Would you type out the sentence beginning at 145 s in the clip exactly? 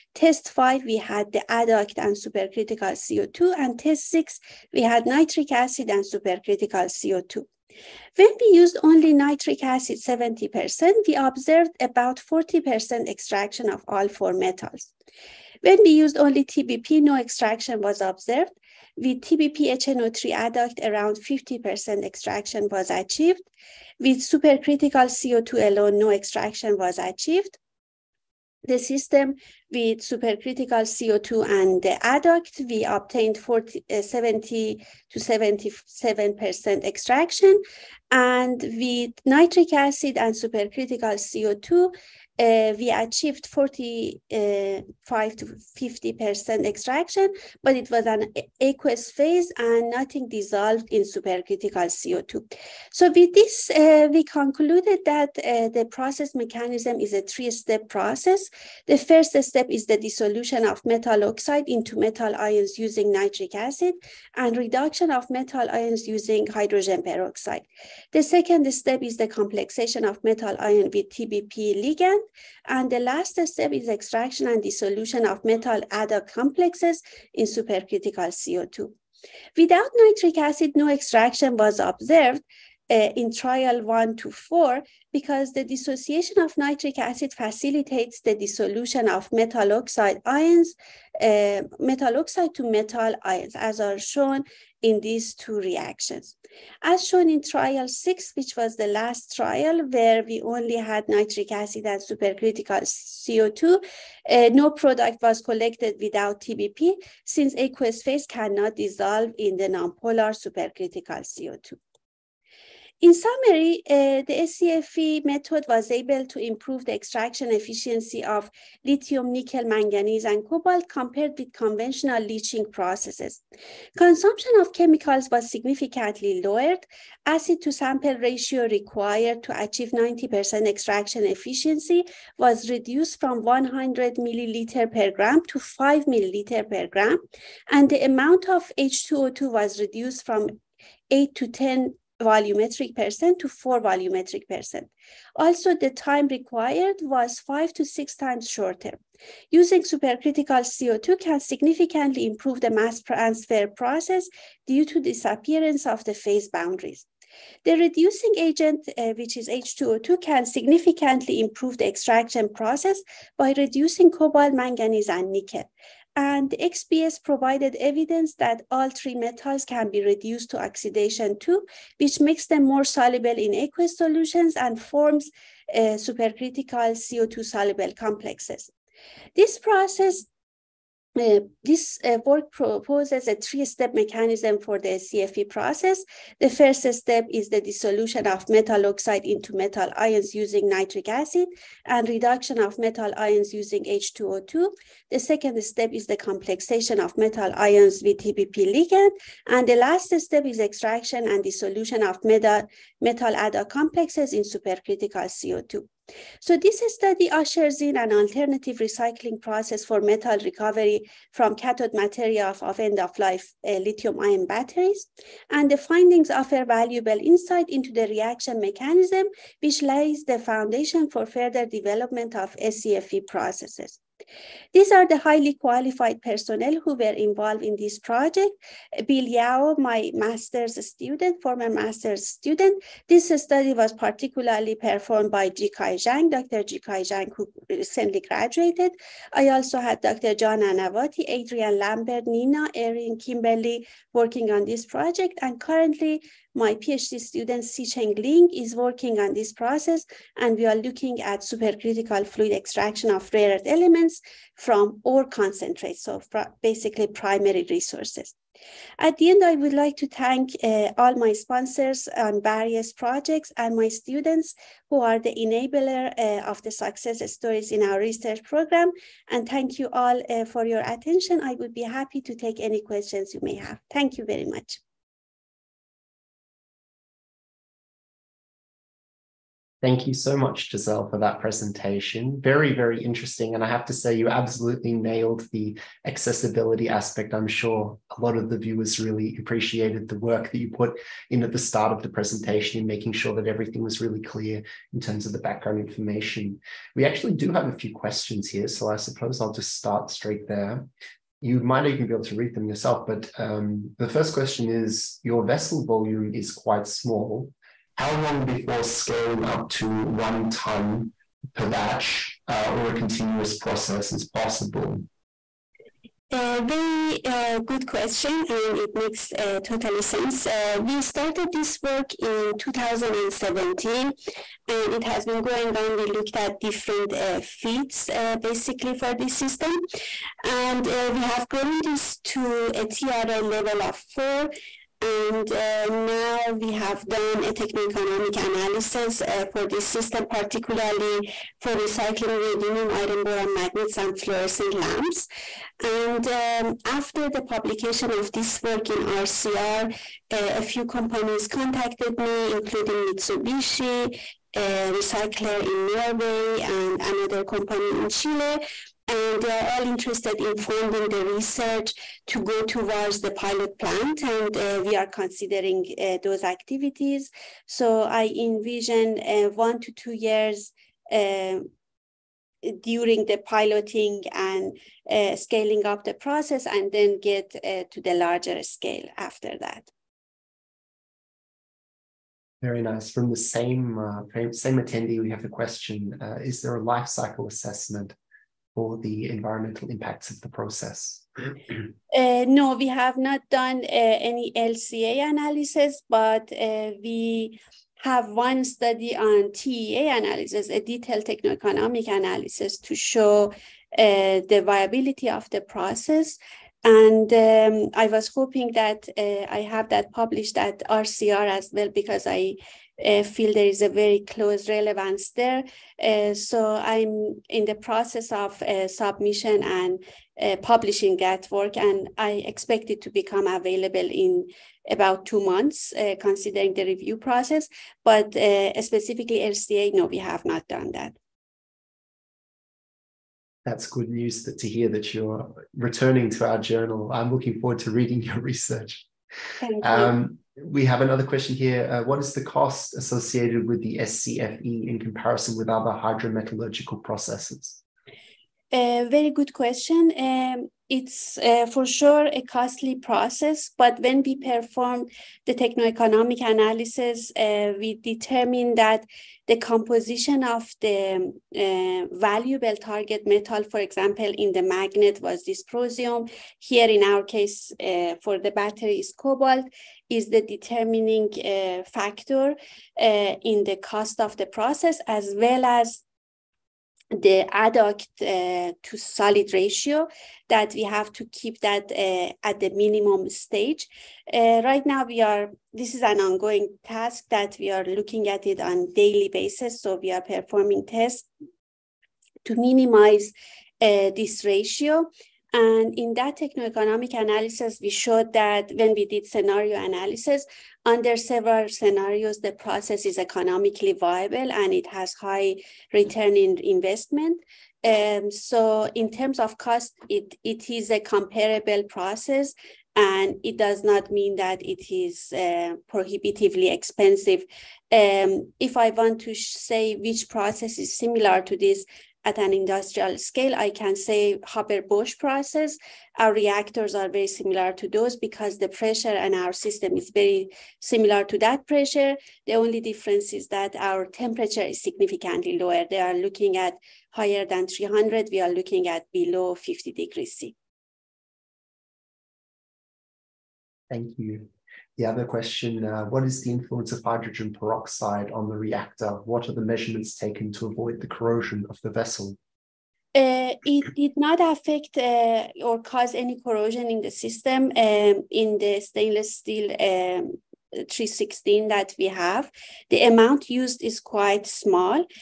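Also, the time required was 5 to 6 times shorter.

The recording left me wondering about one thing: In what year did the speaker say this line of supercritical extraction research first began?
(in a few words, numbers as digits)
2017.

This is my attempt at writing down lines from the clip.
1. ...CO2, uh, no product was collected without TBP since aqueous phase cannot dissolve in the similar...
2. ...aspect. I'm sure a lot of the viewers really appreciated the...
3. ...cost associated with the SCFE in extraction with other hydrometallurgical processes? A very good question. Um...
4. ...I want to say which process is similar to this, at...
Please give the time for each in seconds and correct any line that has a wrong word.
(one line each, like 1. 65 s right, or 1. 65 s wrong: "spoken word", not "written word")
1. 103 s wrong: "nonpolar", not "similar"
2. 286 s right
3. 442 s wrong: "comparison", not "extraction"
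4. 518 s right.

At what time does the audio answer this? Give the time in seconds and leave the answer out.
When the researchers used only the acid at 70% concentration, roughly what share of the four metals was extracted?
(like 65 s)
11 s.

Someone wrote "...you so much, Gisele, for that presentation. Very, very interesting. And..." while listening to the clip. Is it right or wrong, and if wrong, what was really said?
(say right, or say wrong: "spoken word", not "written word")
right.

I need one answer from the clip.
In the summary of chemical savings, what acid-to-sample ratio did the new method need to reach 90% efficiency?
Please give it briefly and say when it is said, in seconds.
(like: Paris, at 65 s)
5 milliliters per gram, at 135 s.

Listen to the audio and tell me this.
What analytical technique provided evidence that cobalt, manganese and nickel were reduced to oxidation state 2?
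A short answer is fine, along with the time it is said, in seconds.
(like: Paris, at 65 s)
XPS, at 166 s.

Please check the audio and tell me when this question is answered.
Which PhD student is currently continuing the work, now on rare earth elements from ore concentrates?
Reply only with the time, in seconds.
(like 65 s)
247 s.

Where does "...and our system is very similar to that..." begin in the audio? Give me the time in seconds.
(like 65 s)
529 s.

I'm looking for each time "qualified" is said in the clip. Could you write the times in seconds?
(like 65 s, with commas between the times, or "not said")
225 s.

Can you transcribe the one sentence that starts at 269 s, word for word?
And thank you all uh, for your attention.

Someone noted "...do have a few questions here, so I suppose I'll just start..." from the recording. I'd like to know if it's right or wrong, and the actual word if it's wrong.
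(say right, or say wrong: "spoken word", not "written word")
right.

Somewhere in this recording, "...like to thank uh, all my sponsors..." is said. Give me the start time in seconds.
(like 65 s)
259 s.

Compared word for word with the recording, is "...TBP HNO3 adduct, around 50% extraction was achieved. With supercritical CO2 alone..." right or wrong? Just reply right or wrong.
right.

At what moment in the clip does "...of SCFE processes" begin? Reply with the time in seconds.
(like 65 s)
222 s.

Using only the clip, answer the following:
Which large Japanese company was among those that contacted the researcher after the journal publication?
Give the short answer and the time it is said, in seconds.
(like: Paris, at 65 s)
Mitsubishi, at 353 s.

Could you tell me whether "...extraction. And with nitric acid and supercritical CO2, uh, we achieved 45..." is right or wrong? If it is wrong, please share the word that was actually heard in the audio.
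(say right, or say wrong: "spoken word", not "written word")
right.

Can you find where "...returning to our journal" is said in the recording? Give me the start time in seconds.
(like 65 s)
435 s.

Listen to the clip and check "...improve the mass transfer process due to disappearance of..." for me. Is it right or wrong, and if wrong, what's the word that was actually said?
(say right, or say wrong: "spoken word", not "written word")
right.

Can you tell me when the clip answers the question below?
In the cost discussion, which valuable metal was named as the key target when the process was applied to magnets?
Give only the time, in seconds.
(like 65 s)
465 s.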